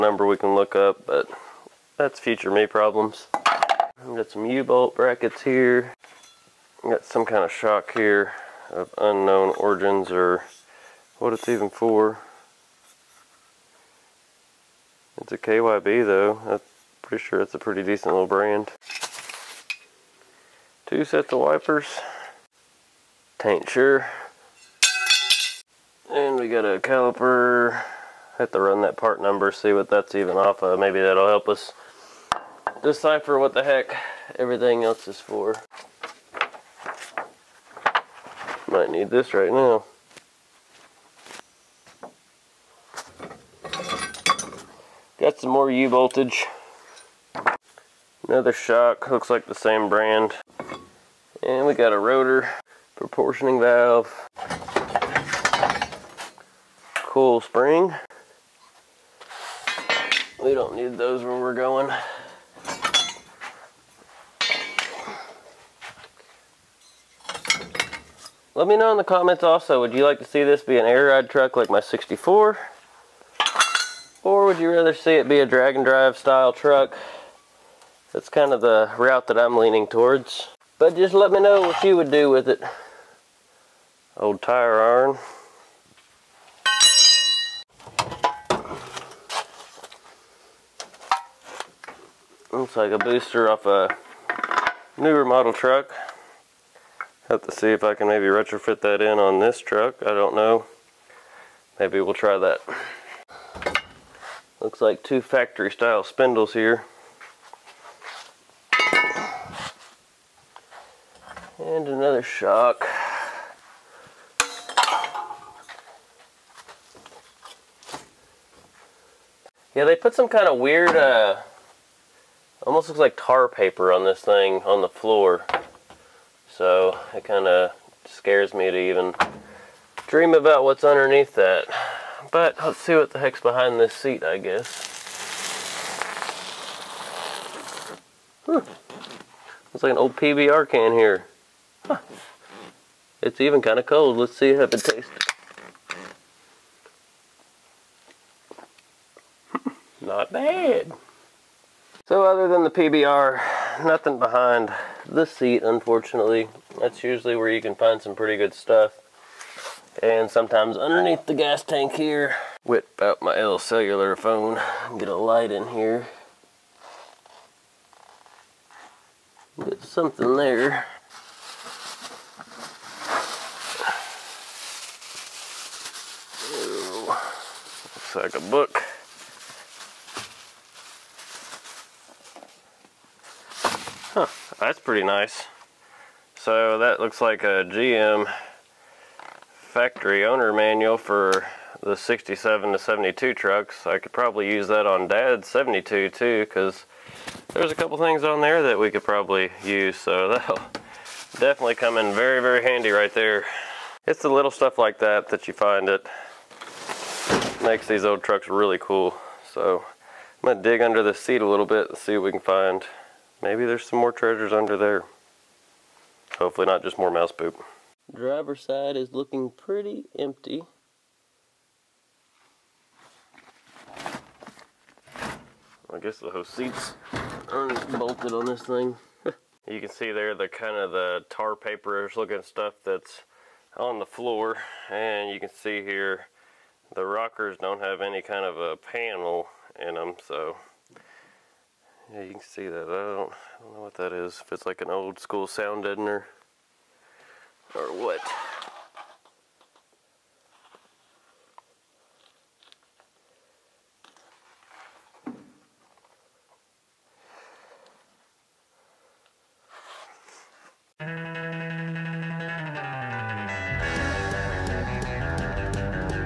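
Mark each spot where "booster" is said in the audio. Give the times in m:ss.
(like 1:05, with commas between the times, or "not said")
1:32.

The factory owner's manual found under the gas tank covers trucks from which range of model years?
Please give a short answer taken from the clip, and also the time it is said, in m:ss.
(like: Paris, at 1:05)
67 to 72, at 3:11.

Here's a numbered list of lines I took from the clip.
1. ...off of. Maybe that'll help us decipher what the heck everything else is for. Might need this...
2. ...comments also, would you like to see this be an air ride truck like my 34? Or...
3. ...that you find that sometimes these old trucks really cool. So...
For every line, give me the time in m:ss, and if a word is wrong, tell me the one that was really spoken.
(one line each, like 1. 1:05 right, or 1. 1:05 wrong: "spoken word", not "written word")
1. 0:30 right
2. 1:09 wrong: "64", not "34"
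3. 3:25 wrong: "makes", not "sometimes".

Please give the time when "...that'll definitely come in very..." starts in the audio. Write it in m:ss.
3:20.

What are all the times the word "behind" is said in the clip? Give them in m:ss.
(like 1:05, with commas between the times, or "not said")
2:13, 2:34.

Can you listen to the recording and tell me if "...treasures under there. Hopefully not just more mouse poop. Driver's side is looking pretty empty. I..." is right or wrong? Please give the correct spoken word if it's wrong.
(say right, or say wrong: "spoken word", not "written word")
right.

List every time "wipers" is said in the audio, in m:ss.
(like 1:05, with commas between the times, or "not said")
0:21.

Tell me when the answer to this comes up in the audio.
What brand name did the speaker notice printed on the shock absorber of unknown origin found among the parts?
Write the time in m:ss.
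0:15.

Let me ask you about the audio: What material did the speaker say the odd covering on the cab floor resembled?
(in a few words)
tar paper.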